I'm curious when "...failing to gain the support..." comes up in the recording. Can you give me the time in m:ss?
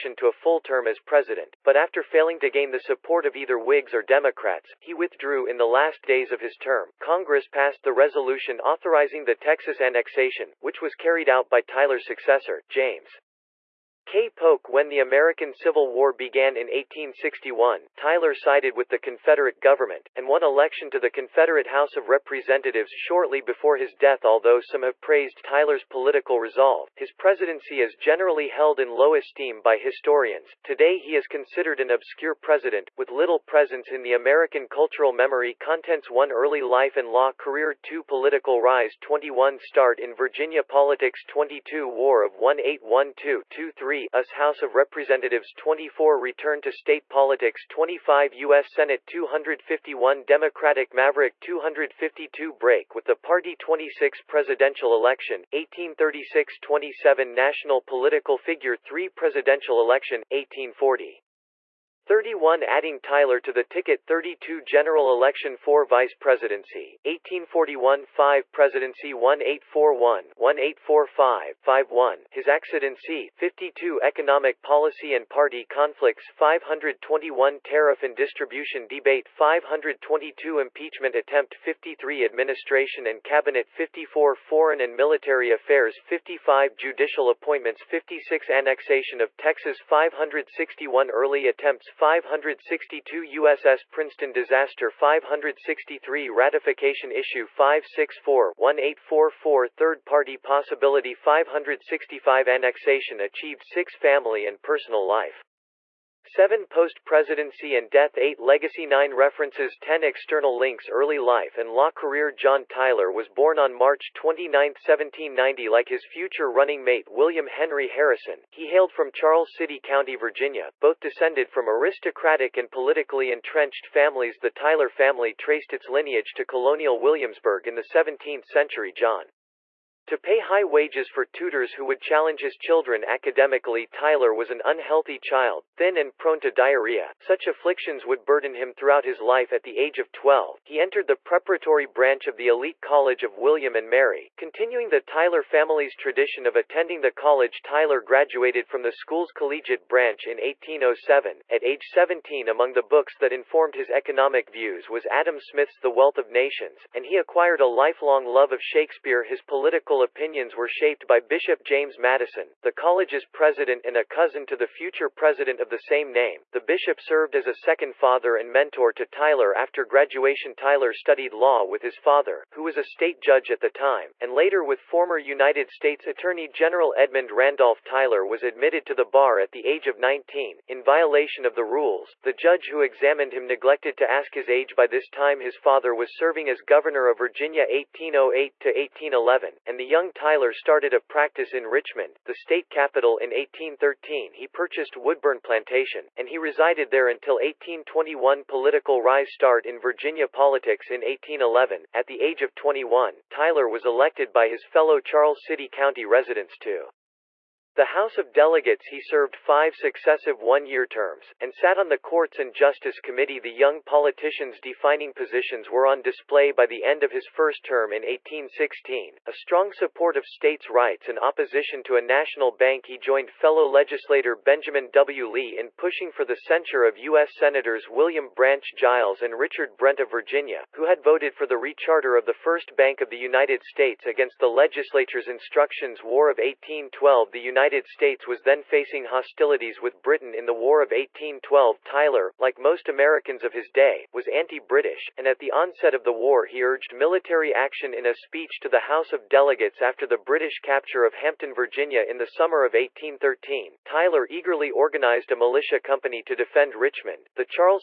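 0:02.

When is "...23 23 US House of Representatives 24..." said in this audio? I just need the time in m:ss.
0:43.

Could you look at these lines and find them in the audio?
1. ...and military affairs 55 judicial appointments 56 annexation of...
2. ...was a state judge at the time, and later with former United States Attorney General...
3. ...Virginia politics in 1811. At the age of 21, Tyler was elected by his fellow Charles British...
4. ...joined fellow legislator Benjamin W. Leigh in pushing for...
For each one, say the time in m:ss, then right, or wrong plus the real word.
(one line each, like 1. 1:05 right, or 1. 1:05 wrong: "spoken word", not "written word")
1. 1:24 right
2. 2:52 right
3. 3:19 wrong: "City", not "British"
4. 3:42 right.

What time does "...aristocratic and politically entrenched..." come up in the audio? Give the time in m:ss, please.
2:01.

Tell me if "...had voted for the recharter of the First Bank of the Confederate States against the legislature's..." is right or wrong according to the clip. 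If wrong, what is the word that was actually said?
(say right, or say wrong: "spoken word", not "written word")
wrong: "United", not "Confederate".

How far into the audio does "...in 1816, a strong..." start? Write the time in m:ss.
3:37.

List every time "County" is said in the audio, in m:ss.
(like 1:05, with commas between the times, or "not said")
1:59, 3:25.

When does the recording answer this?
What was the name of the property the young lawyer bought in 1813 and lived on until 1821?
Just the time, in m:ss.
3:14.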